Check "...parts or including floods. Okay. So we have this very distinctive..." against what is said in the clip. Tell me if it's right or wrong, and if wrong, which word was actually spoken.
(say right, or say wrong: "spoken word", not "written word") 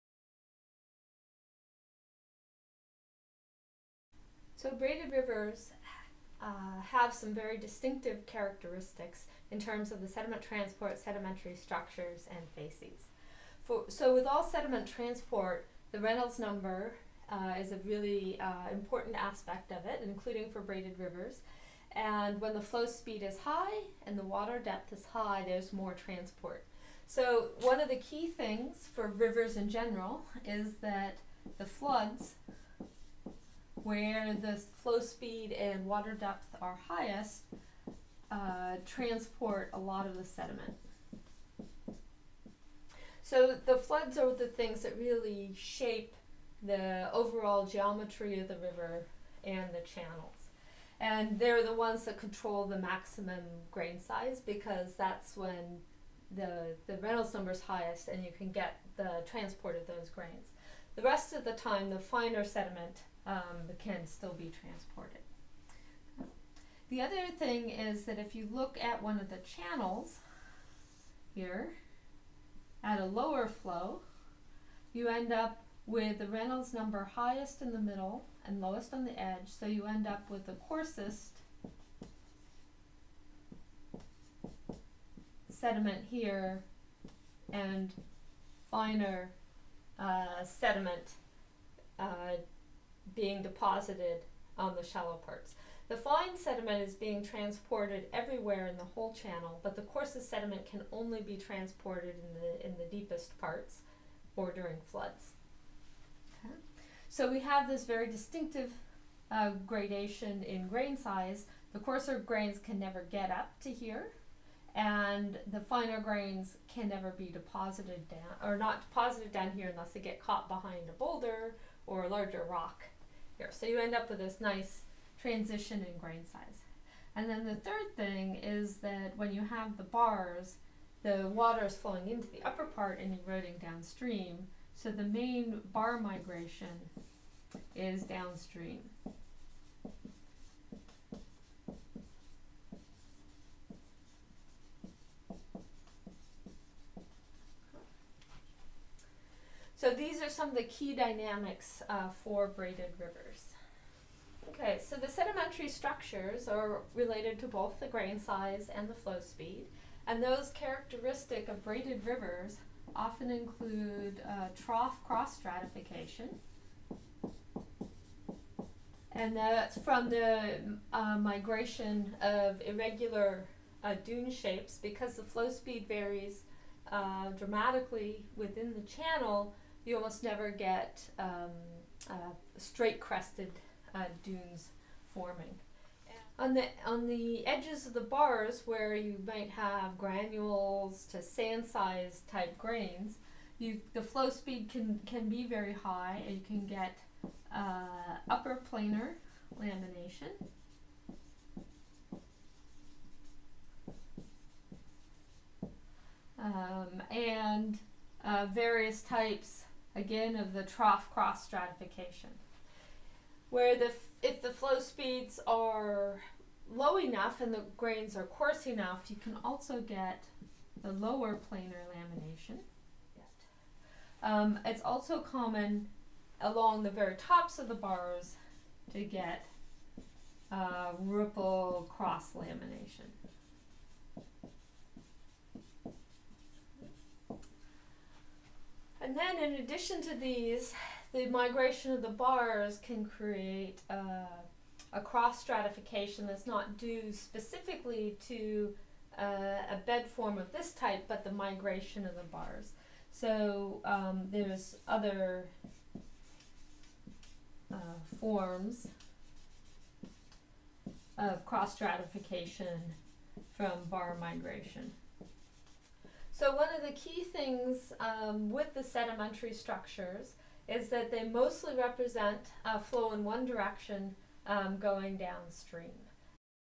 wrong: "during", not "including".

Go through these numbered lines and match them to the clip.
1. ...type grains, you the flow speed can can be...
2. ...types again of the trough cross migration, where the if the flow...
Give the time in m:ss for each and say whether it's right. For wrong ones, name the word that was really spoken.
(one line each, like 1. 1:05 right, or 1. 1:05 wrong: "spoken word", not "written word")
1. 3:12 right
2. 3:29 wrong: "stratification", not "migration".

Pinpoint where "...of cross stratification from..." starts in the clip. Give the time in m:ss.
4:21.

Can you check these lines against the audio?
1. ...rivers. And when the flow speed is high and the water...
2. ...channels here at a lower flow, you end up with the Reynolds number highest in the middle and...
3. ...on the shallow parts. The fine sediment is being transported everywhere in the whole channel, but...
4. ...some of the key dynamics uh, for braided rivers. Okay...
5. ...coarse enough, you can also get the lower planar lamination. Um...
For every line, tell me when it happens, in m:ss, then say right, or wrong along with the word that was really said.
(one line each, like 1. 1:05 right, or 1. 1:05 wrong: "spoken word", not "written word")
1. 0:20 right
2. 1:09 right
3. 1:34 right
4. 2:30 right
5. 3:38 right.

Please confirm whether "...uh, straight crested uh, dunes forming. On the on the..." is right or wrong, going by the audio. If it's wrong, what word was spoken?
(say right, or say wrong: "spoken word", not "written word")
right.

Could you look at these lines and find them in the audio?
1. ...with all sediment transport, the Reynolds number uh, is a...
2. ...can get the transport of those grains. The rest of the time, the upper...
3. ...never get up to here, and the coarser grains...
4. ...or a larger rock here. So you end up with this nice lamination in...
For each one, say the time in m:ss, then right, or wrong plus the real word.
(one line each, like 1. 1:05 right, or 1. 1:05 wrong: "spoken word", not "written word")
1. 0:14 right
2. 0:58 wrong: "finer", not "upper"
3. 1:52 wrong: "finer", not "coarser"
4. 2:01 wrong: "transition", not "lamination".